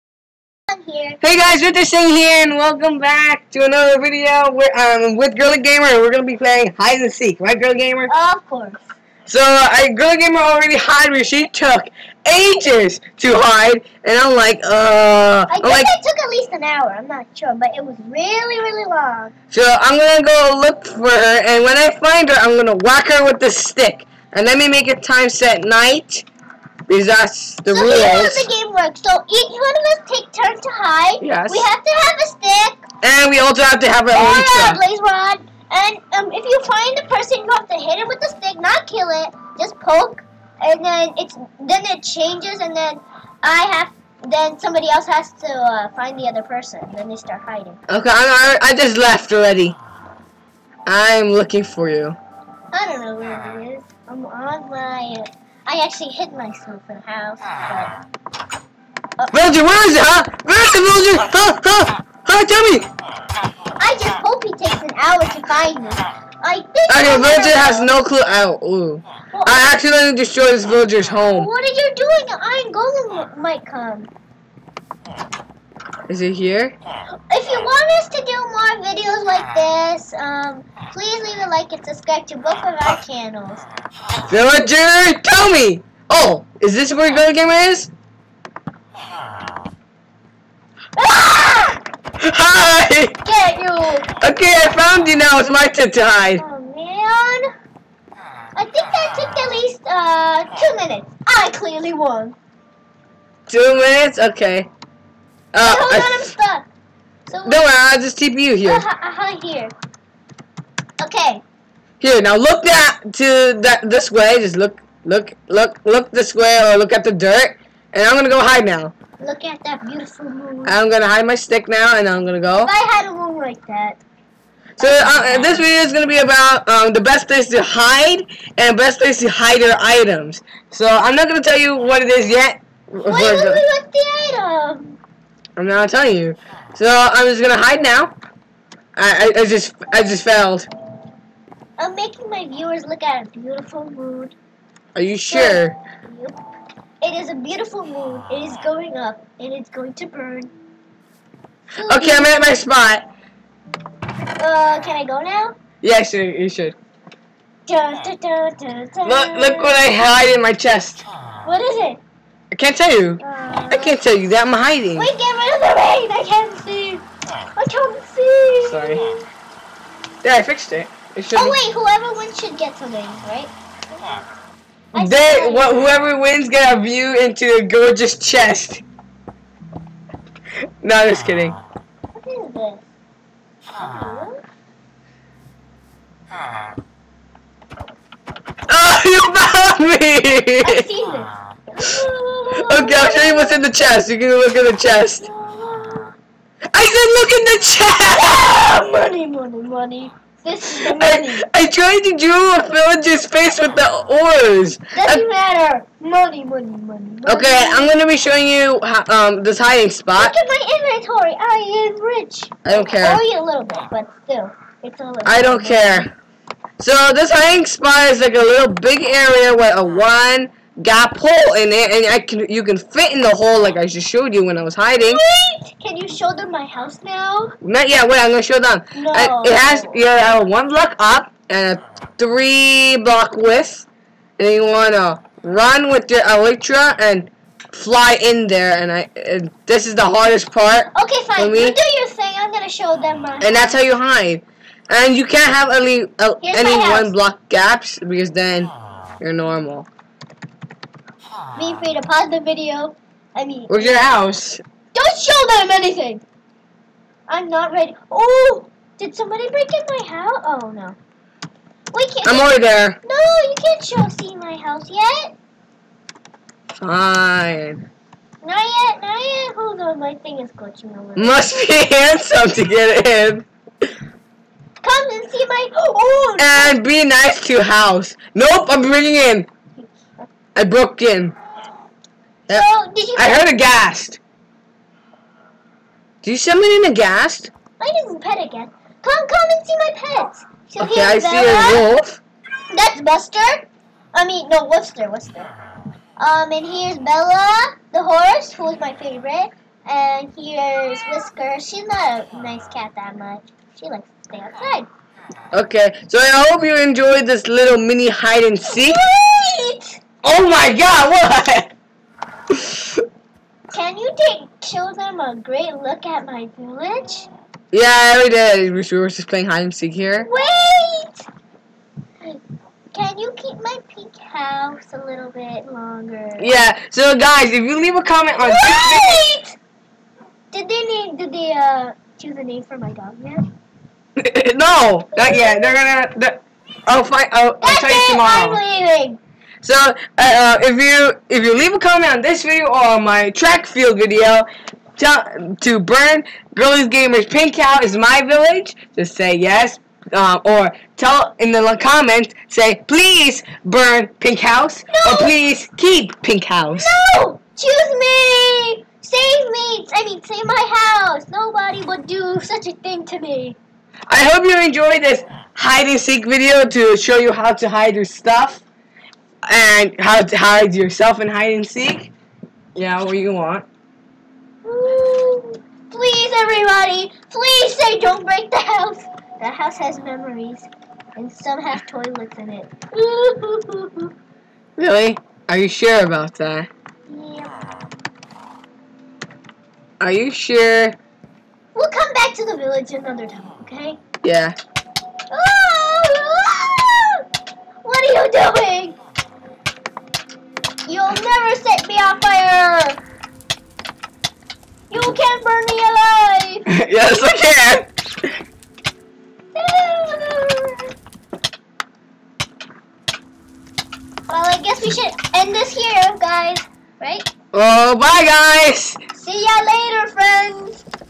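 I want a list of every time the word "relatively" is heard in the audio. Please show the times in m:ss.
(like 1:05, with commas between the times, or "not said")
not said.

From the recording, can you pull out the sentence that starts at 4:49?
Come, come and see my pets.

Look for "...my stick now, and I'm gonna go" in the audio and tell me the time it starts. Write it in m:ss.
2:01.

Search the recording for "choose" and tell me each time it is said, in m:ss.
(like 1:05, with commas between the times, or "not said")
5:32, 5:57.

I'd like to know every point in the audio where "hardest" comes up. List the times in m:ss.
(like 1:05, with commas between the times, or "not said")
4:00.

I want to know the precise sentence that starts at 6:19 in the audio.
The house has memories, and some have toilets in it.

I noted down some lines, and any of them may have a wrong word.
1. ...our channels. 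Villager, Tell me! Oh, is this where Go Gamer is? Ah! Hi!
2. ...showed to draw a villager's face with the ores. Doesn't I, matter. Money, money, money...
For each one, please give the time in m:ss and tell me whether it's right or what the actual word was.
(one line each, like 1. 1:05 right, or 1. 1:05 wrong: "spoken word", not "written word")
1. 1:22 right
2. 3:21 wrong: "tried", not "showed".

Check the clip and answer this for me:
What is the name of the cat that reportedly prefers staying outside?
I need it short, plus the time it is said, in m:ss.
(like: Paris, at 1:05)
Whisker, at 5:01.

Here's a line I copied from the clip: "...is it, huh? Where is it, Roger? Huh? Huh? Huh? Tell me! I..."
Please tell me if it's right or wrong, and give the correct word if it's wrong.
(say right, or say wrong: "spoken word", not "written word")
right.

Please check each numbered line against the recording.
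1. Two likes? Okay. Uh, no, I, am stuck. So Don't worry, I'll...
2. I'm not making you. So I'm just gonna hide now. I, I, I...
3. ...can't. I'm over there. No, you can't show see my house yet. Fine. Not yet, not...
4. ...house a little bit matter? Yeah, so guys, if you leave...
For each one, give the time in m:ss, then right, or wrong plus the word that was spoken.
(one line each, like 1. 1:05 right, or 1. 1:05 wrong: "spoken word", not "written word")
1. 1:43 wrong: "minutes", not "likes"
2. 2:15 wrong: "telling", not "making"
3. 4:22 right
4. 5:24 wrong: "longer", not "matter".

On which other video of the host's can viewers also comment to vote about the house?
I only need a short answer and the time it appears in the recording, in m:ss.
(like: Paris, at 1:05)
Track field video, at 5:43.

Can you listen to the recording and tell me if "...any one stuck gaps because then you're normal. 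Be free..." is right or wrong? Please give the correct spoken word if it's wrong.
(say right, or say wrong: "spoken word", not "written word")
wrong: "block", not "stuck".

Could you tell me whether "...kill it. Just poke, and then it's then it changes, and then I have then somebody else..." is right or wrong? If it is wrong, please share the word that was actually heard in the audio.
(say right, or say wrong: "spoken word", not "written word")
right.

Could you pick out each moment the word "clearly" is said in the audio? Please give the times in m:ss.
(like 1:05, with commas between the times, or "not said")
1:41.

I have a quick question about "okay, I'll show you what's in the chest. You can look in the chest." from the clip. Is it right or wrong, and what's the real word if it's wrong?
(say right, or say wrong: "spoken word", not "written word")
right.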